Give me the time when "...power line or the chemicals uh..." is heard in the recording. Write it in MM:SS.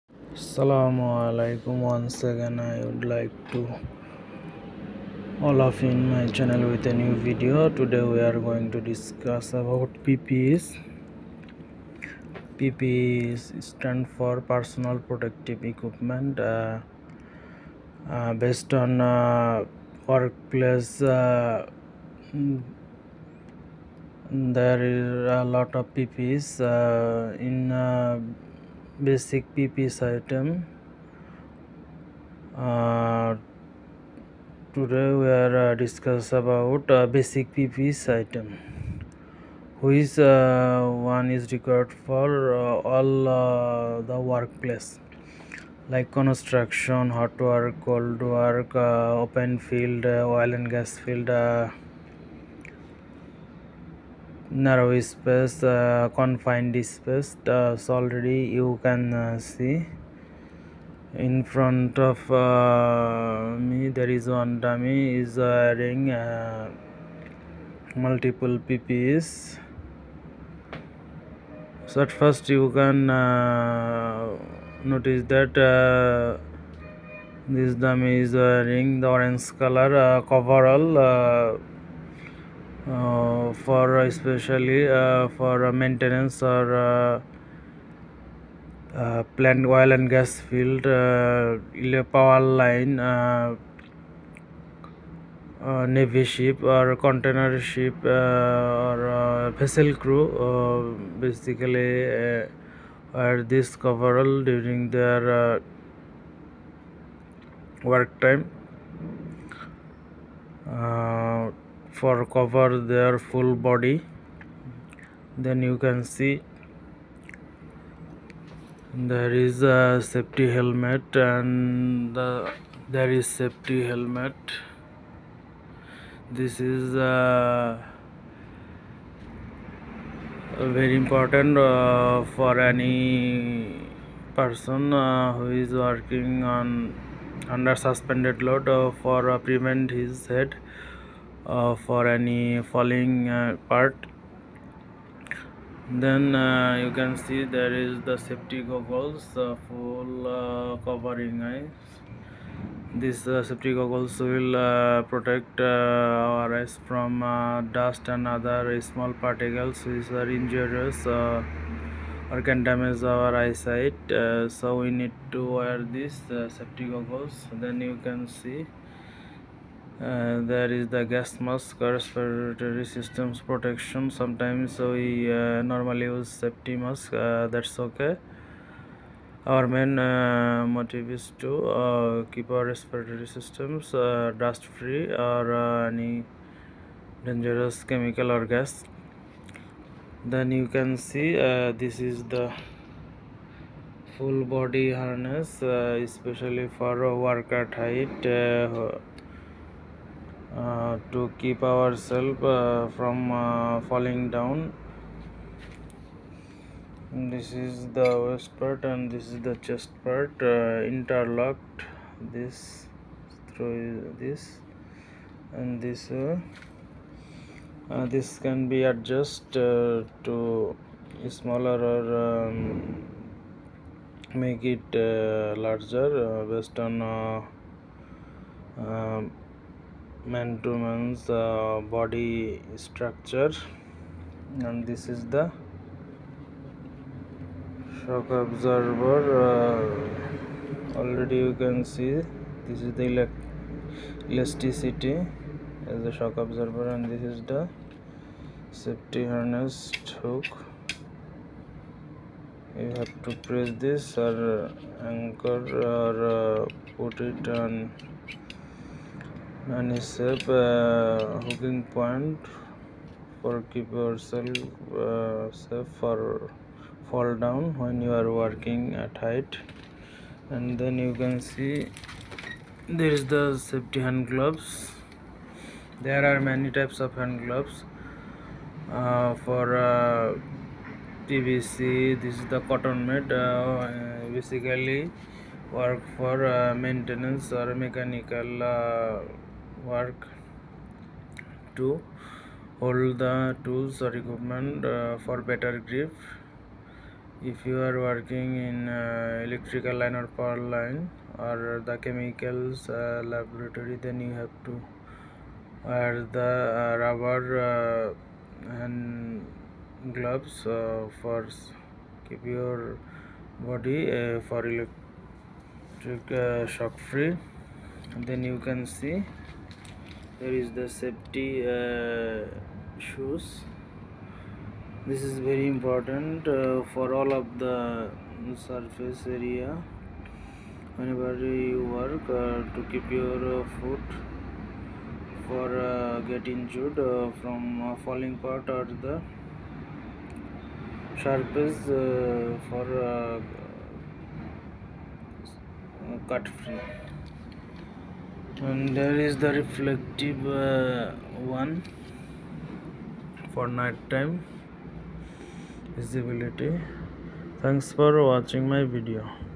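05:00.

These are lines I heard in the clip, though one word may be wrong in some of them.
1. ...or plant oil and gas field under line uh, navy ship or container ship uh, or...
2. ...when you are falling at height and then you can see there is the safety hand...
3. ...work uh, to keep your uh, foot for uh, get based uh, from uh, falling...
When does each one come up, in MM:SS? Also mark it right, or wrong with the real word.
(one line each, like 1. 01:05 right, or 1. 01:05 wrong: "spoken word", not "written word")
1. 01:26 wrong: "power", not "under"
2. 04:27 wrong: "working", not "falling"
3. 05:31 wrong: "injured", not "based".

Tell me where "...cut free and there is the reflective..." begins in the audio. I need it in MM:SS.
05:46.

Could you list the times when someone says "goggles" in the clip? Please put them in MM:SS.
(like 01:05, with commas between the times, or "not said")
02:28, 02:33, 02:46.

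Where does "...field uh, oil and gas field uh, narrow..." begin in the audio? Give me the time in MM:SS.
00:49.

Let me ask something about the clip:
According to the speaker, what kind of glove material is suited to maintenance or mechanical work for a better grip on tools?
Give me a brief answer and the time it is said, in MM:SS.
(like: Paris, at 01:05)
Cotton, at 04:42.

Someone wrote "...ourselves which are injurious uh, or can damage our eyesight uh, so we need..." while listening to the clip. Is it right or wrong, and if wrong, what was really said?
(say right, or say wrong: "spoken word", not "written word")
wrong: "particles", not "ourselves".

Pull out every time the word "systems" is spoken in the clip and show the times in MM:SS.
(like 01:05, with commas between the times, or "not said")
02:52, 03:03.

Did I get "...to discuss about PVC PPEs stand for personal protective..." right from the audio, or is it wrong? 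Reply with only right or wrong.
wrong.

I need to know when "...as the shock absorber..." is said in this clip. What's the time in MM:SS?
04:05.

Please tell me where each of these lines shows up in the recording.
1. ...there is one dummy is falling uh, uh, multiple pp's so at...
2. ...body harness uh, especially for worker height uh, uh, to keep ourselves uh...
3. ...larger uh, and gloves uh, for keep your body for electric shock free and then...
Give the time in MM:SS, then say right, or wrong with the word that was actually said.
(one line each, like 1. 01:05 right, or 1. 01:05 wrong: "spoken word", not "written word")
1. 01:03 wrong: "wearing", not "falling"
2. 03:14 right
3. 05:06 wrong: "rubber", not "larger".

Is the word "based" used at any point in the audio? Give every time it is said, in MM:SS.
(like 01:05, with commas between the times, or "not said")
00:18, 03:46.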